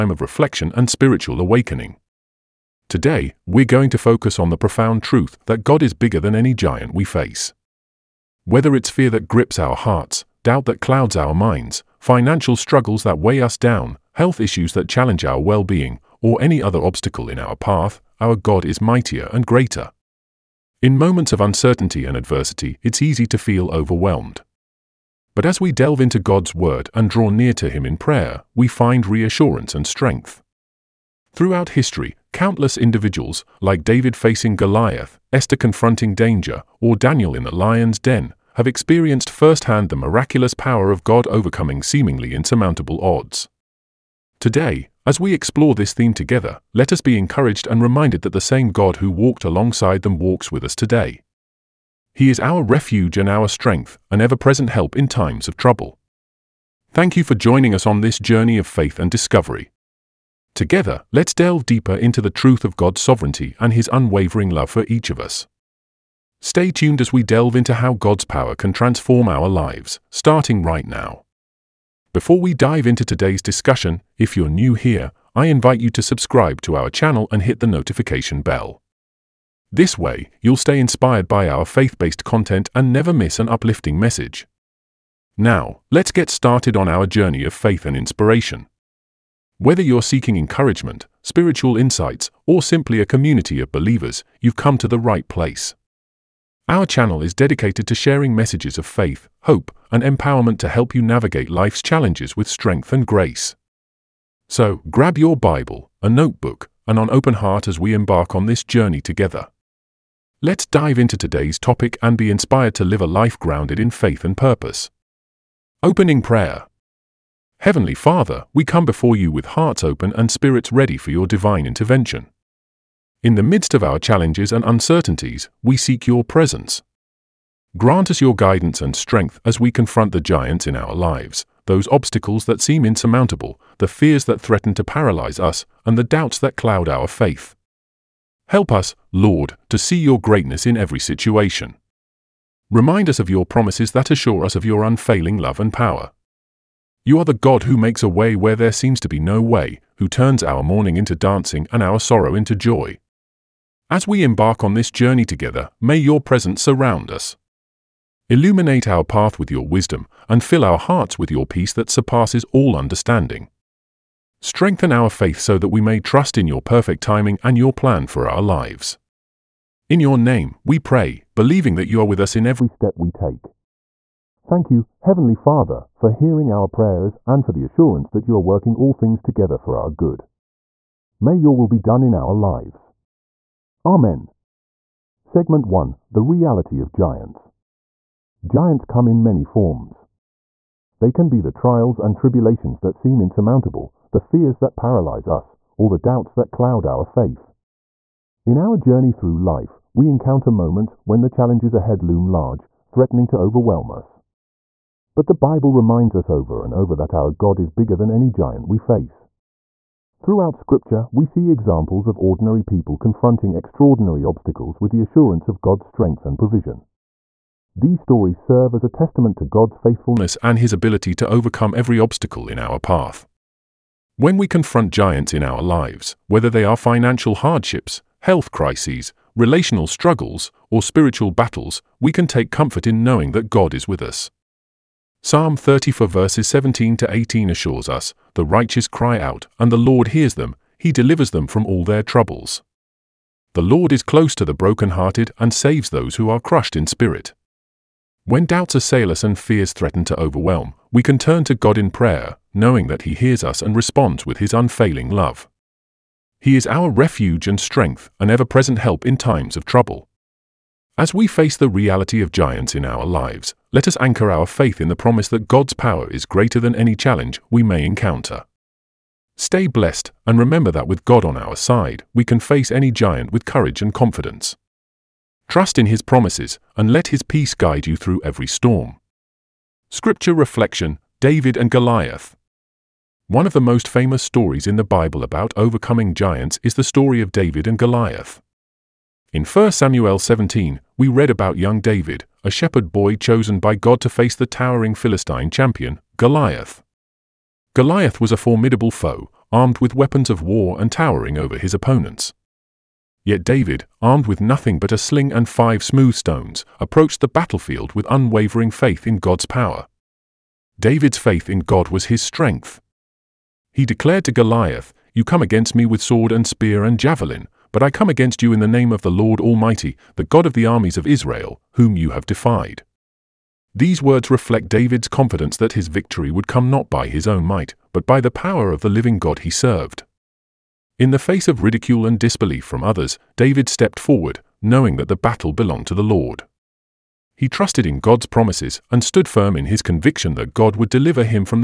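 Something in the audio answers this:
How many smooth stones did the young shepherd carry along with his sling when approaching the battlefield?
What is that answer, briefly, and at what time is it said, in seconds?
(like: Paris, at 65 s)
5, at 305 s.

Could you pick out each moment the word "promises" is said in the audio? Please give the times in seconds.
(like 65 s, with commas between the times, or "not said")
143 s, 264 s, 276 s, 338 s.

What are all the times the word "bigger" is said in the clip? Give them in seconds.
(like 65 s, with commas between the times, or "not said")
5 s, 207 s.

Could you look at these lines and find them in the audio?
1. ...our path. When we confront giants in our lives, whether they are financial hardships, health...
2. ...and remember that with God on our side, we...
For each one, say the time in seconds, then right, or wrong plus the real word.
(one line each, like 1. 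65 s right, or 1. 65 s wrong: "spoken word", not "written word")
1. 222 s right
2. 270 s right.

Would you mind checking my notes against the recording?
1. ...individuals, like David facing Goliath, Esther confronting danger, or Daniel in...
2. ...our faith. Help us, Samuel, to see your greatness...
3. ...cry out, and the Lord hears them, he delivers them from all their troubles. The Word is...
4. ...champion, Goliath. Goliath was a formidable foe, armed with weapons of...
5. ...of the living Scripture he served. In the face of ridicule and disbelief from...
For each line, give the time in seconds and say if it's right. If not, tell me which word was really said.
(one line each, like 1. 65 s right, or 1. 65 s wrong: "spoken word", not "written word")
1. 32 s right
2. 136 s wrong: "Lord", not "Samuel"
3. 238 s wrong: "Lord", not "Word"
4. 295 s right
5. 328 s wrong: "God", not "Scripture".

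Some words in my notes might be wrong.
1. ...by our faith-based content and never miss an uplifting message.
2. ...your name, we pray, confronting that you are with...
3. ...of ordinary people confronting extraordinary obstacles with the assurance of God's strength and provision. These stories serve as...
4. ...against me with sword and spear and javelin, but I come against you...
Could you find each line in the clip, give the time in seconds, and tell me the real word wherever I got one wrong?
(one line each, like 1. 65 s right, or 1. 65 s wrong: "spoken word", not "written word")
1. 81 s right
2. 170 s wrong: "believing", not "confronting"
3. 212 s right
4. 315 s right.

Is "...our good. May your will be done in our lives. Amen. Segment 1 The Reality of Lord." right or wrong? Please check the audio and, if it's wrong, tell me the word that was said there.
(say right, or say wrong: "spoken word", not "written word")
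wrong: "Giants", not "Lord".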